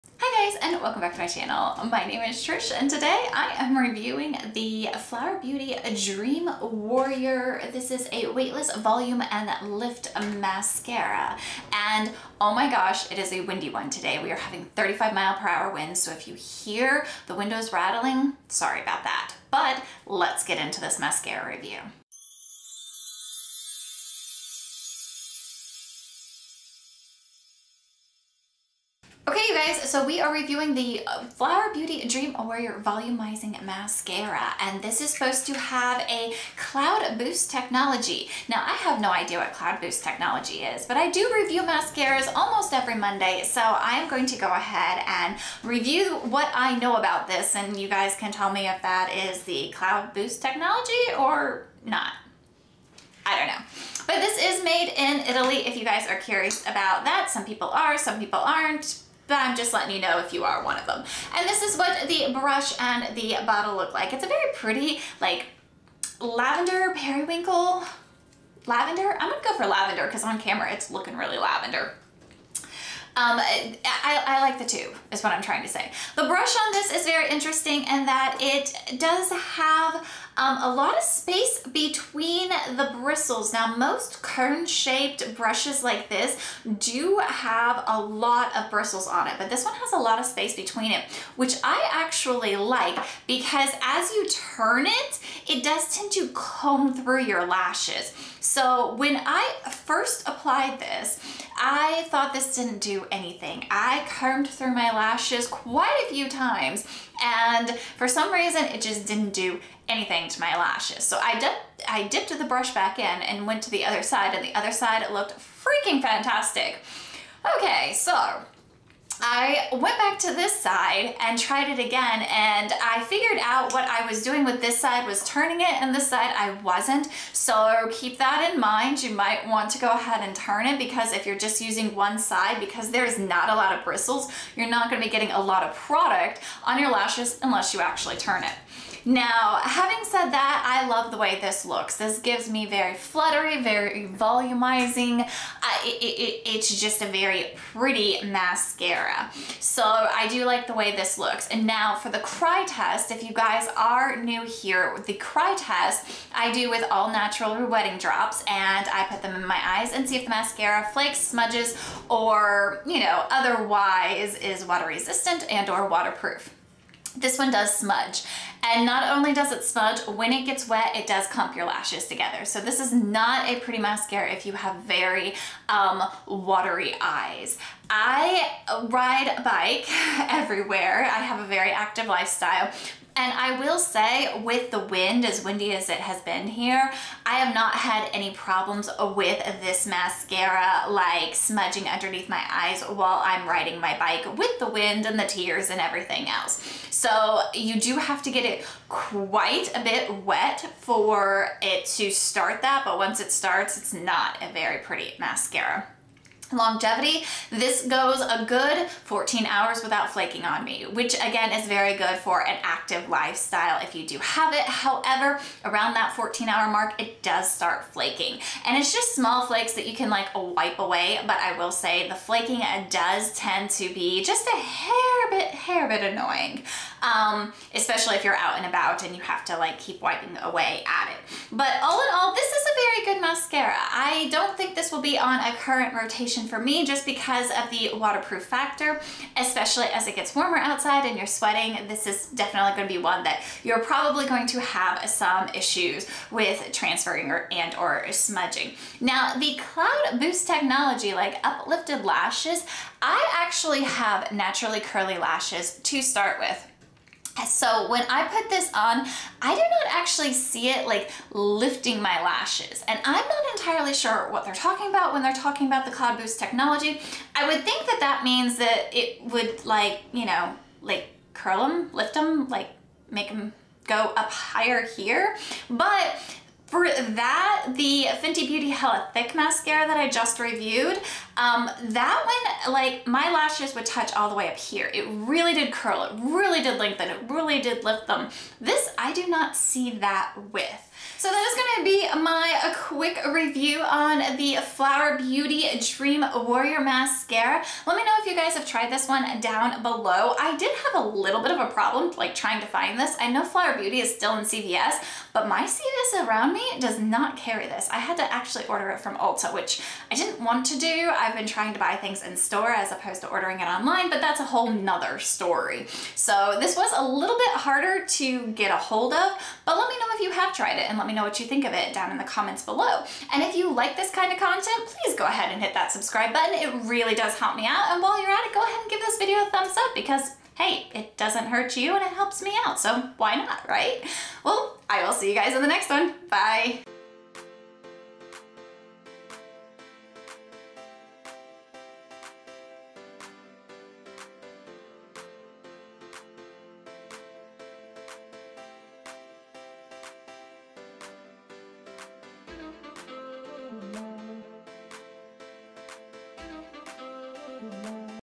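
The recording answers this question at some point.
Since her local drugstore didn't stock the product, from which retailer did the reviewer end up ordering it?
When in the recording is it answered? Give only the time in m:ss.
5:09.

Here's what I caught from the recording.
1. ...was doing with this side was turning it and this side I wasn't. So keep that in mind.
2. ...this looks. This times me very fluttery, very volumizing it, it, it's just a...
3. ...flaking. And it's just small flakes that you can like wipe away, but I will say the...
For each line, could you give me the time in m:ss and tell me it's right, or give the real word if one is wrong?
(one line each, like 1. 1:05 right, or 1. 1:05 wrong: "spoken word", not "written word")
1. 2:04 right
2. 2:21 wrong: "gives", not "times"
3. 3:37 right.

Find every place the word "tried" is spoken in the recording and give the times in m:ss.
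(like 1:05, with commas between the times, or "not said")
2:01, 4:58, 5:20.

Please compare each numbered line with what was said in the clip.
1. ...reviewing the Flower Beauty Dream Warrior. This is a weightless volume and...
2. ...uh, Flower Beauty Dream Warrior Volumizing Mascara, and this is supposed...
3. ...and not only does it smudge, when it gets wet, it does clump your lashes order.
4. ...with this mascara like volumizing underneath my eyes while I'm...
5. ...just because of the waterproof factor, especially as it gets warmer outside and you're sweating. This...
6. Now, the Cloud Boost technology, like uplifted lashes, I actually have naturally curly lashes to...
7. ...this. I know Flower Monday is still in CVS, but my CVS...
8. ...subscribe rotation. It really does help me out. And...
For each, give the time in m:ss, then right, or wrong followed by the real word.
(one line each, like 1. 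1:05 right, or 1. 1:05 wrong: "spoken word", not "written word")
1. 0:03 right
2. 0:31 right
3. 2:48 wrong: "together", not "order"
4. 3:09 wrong: "smudging", not "volumizing"
5. 3:56 right
6. 4:08 right
7. 5:02 wrong: "Beauty", not "Monday"
8. 5:25 wrong: "button", not "rotation".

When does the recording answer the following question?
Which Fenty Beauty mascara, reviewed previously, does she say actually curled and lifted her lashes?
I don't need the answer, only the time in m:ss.
4:38.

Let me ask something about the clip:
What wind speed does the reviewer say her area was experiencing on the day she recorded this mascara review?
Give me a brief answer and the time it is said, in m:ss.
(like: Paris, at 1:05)
35 mph, at 0:14.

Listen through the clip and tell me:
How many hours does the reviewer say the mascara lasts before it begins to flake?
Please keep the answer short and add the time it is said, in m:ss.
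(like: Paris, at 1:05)
14 hours, at 3:29.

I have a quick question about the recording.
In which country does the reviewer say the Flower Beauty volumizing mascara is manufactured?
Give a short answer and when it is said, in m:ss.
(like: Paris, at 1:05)
Italy, at 0:55.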